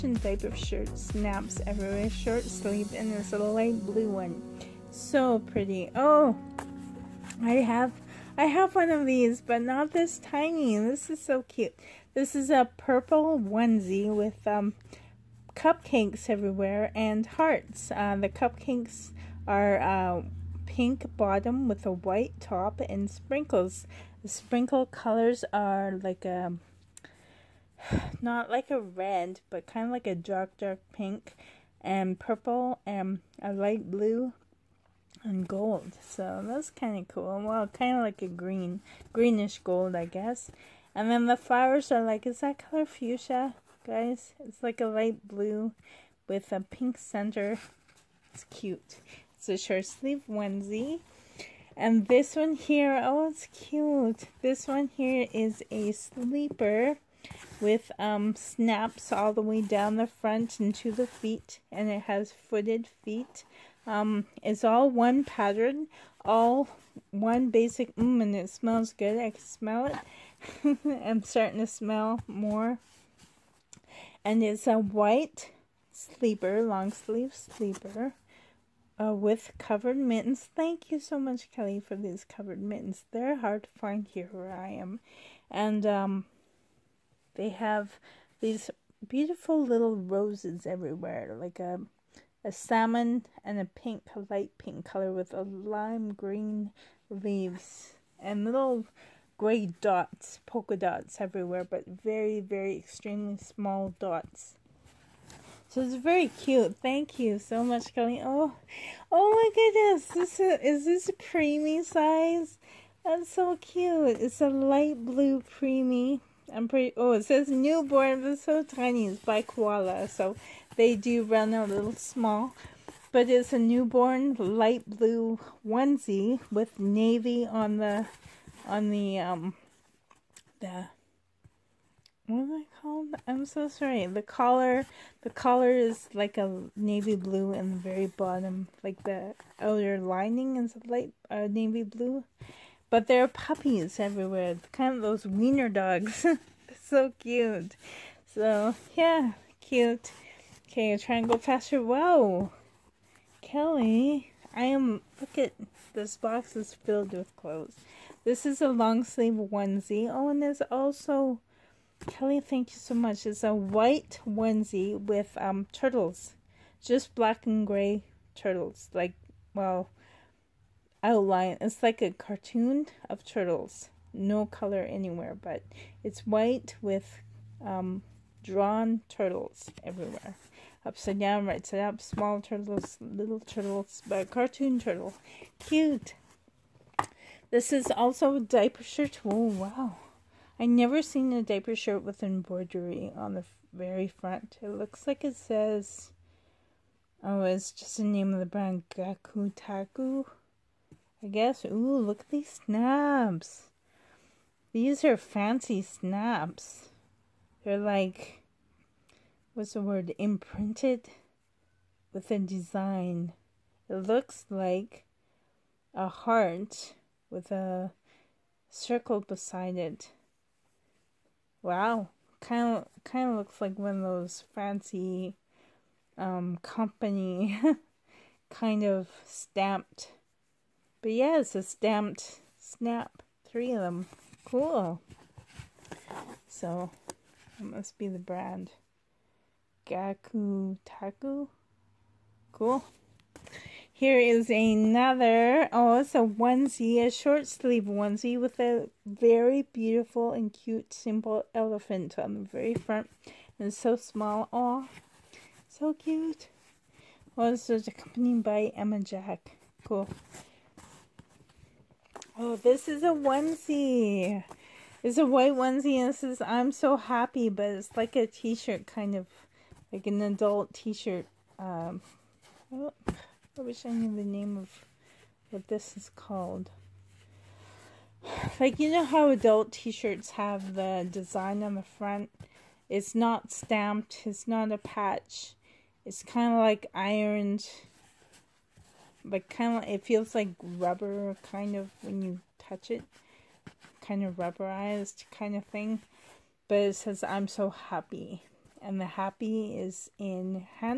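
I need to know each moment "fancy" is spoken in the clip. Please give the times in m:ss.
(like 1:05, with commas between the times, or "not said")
3:25, 3:44.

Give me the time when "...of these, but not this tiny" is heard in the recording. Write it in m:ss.
0:08.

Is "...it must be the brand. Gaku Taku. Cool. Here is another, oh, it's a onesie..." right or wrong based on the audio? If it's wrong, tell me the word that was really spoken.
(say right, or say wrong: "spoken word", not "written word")
right.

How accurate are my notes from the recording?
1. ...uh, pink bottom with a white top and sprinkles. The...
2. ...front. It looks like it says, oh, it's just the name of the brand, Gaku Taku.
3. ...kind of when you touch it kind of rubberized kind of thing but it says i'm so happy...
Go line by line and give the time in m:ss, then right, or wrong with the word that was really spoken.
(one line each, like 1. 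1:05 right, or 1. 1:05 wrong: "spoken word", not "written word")
1. 0:19 right
2. 3:14 right
3. 4:51 right.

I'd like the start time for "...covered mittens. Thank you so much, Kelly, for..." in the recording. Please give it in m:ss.
1:19.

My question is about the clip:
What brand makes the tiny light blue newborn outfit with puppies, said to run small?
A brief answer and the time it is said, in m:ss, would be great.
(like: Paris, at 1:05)
Koala, at 1:59.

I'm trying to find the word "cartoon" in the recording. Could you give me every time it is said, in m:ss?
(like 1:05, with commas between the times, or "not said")
2:52, 3:04.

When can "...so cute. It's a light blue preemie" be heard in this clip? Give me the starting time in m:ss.
1:53.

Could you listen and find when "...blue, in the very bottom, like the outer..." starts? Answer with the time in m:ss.
2:17.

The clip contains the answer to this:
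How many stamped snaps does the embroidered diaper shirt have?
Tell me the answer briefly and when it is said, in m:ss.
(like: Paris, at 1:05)
3, at 3:53.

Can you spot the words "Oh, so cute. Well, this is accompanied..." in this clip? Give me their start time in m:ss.
4:14.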